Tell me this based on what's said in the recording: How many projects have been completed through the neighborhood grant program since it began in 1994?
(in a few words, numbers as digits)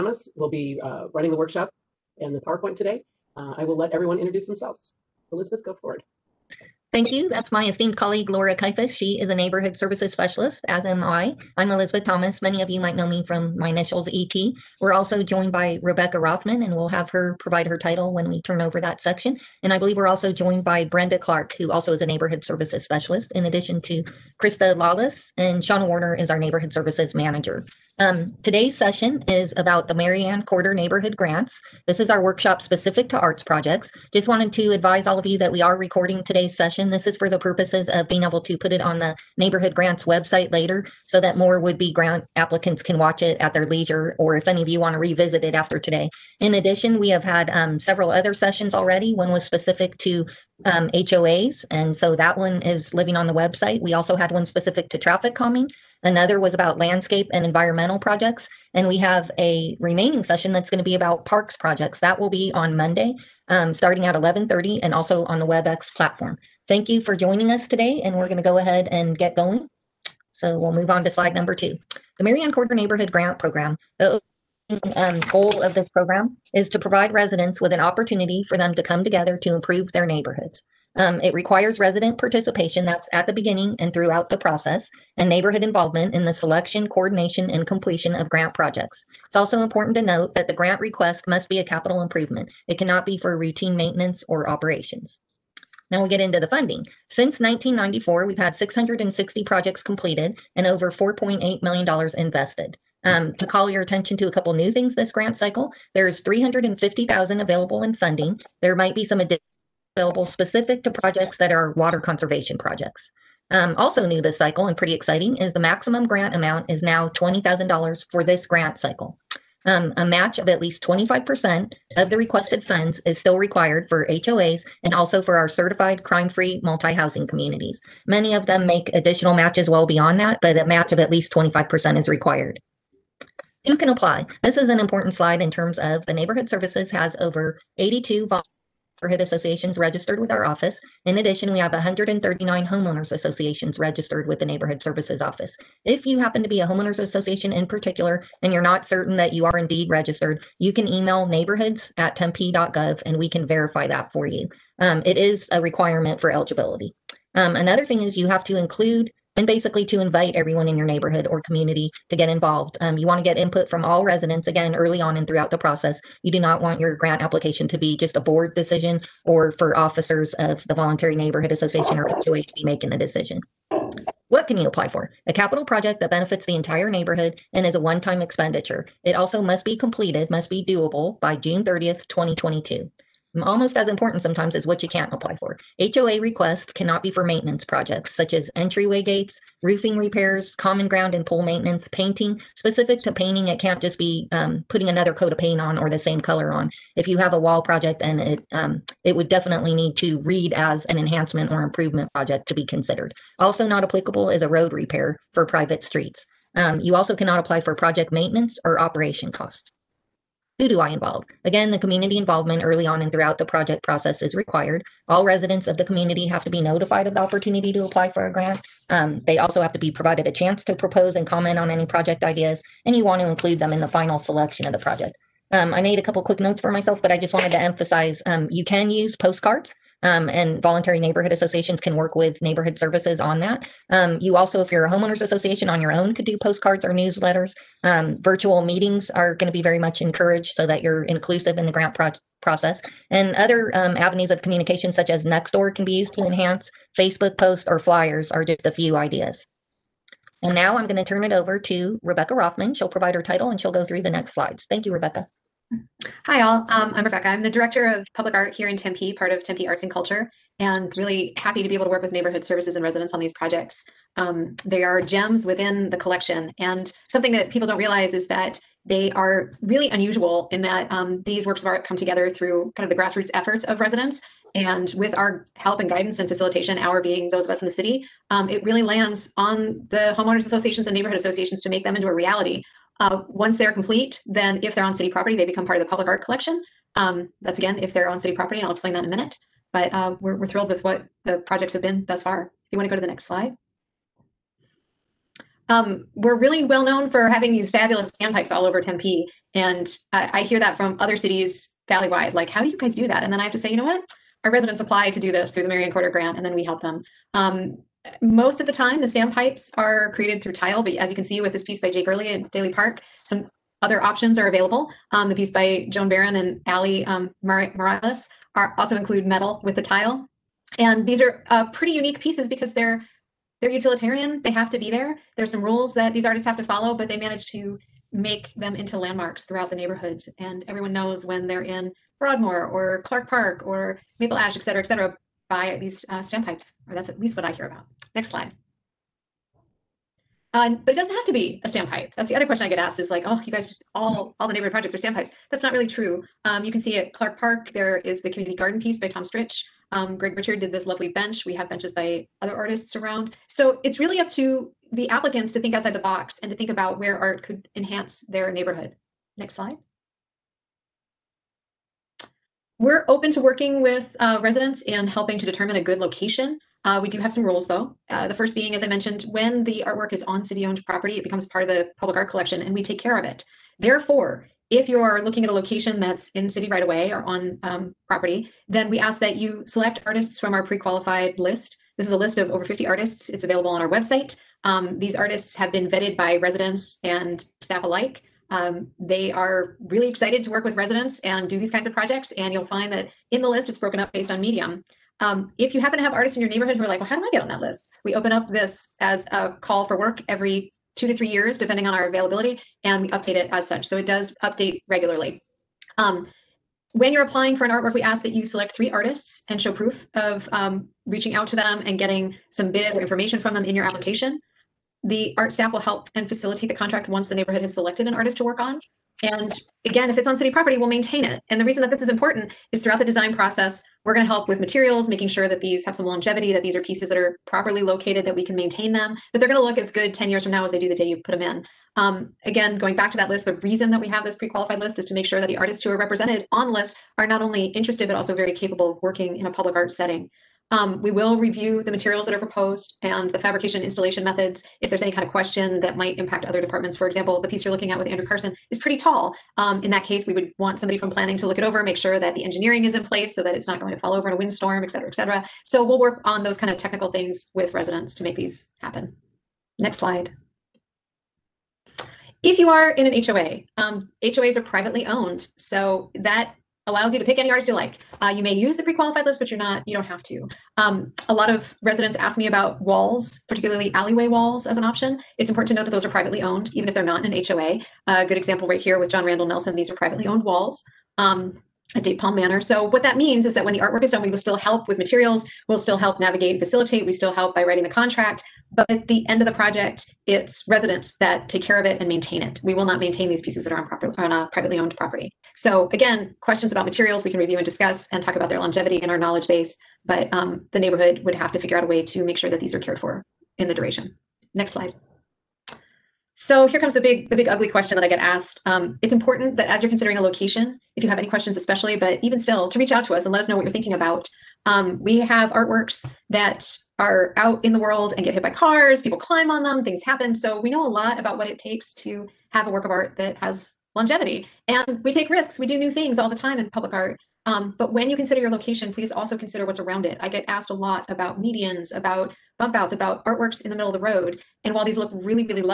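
660.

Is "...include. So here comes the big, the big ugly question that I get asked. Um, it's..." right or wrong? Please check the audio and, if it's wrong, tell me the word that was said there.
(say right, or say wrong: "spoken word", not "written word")
wrong: "slide", not "include".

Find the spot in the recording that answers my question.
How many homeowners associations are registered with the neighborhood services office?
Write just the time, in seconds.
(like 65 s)
141 s.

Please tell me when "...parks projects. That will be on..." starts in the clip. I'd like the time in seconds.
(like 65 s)
61 s.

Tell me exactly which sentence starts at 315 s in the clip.
Um, the piece by Joan Barron and Ali um, Morales are also include metal with the tile.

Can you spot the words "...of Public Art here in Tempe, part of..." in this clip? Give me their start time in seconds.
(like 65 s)
257 s.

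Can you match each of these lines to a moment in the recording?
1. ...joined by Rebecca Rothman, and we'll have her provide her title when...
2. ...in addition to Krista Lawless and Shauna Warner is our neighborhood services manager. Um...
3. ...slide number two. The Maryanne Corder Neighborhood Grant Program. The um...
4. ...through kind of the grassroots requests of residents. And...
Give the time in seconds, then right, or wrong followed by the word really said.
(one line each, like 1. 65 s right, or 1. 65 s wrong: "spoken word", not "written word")
1. 15 s right
2. 23 s right
3. 71 s right
4. 272 s wrong: "efforts", not "requests".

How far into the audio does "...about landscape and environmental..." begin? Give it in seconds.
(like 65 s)
56 s.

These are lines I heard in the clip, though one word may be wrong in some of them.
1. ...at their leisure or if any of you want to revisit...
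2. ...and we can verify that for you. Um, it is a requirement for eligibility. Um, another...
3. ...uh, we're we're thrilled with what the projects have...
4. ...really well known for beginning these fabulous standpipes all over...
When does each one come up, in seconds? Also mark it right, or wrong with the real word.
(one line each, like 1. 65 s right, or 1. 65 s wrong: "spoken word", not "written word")
1. 43 s right
2. 153 s right
3. 289 s right
4. 296 s wrong: "having", not "beginning".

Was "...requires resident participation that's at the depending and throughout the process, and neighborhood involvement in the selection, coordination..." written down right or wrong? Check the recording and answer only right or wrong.
wrong.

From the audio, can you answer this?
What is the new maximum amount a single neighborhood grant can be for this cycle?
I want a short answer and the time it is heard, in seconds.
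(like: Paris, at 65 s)
$20,000, at 117 s.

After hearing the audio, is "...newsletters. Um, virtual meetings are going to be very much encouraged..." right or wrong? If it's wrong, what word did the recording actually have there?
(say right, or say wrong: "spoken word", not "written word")
right.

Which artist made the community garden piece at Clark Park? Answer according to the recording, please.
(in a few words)
Tom Stritch.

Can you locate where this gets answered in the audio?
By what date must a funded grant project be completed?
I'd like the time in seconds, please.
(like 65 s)
181 s.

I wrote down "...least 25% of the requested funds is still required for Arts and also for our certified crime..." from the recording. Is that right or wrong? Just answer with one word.
wrong.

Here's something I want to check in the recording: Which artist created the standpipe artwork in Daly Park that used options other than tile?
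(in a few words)
Jake Early.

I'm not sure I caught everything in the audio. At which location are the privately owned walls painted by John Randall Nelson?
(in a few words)
Date Palm Manor.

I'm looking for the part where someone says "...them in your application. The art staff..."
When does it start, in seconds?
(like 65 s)
413 s.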